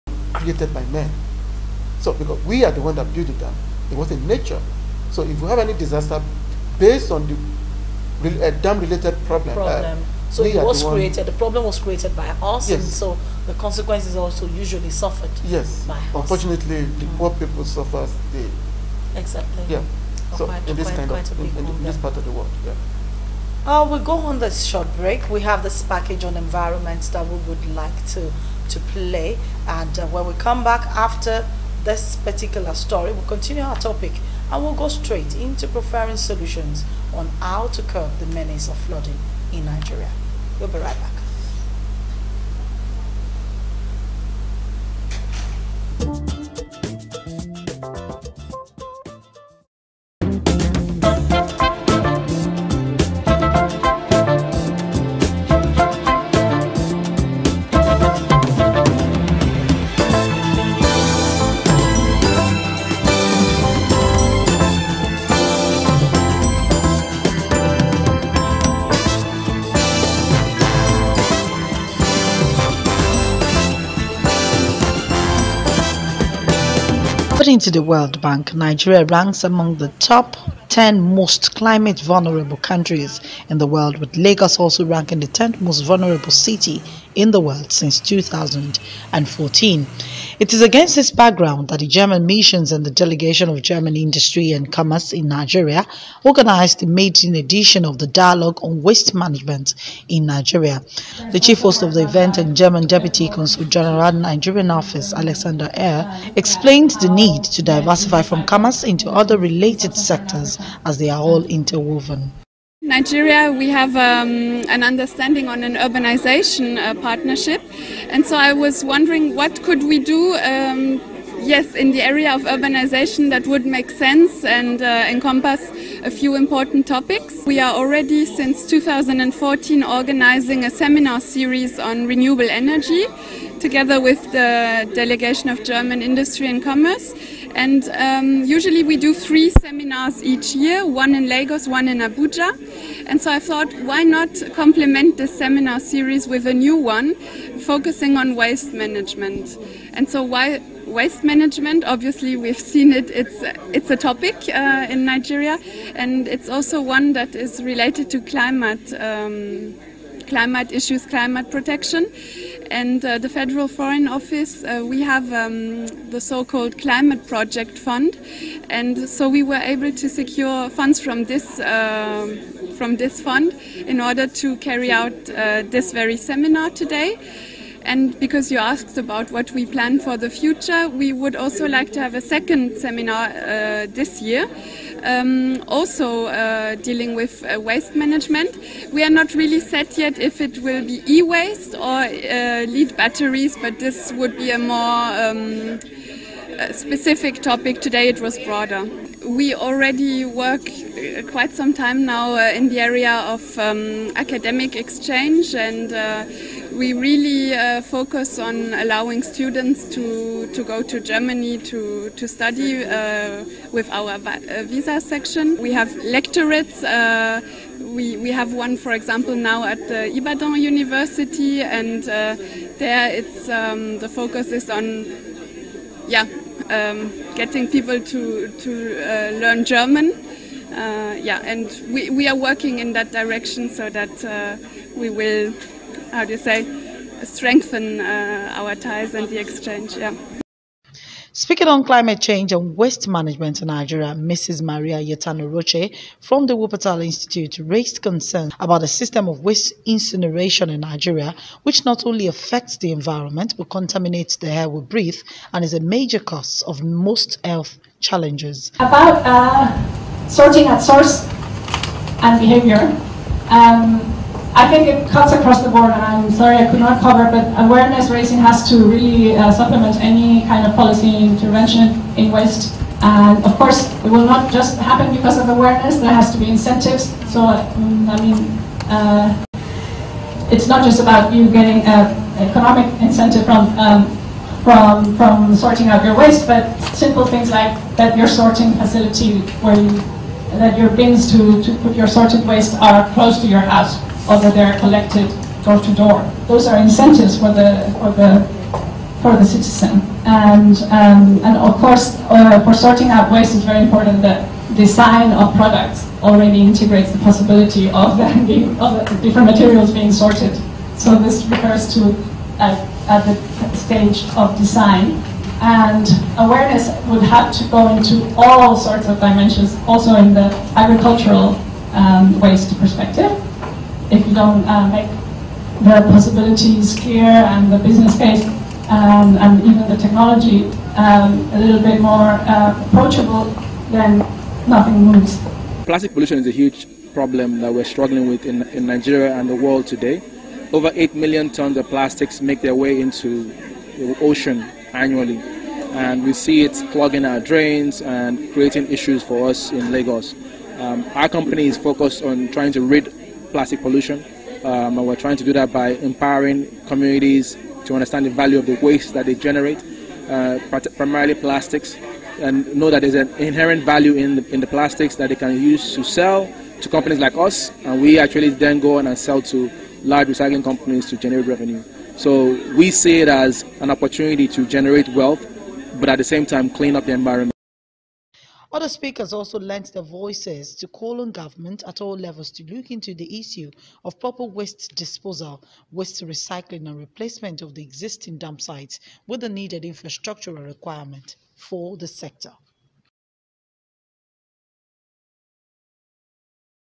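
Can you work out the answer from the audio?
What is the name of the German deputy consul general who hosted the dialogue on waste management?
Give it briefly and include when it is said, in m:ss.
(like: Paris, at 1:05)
Alexander Eyre, at 1:45.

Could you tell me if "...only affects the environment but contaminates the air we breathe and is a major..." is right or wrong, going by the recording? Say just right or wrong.
right.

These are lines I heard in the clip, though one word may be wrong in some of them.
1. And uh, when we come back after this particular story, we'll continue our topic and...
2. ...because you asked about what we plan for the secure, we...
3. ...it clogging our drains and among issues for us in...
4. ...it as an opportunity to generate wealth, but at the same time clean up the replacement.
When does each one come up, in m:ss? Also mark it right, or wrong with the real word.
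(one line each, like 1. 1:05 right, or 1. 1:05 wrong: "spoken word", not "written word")
1. 0:29 right
2. 2:58 wrong: "future", not "secure"
3. 5:46 wrong: "creating", not "among"
4. 6:13 wrong: "environment", not "replacement".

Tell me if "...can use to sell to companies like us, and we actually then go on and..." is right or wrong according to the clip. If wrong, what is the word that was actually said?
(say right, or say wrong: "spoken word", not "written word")
right.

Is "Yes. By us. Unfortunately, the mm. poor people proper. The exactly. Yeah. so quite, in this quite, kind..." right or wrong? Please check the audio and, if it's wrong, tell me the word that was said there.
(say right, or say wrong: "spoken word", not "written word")
wrong: "suffer", not "proper".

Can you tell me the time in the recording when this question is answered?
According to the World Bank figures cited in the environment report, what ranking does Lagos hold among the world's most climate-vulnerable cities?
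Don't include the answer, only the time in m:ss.
1:25.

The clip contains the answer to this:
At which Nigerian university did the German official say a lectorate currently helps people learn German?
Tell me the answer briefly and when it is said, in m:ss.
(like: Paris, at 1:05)
Ibadan University, at 3:40.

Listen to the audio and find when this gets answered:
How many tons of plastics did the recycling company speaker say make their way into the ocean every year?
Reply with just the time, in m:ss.
5:40.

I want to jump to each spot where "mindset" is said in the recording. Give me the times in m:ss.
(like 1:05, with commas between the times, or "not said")
not said.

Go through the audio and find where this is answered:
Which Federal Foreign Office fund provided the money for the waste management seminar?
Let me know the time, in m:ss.
2:46.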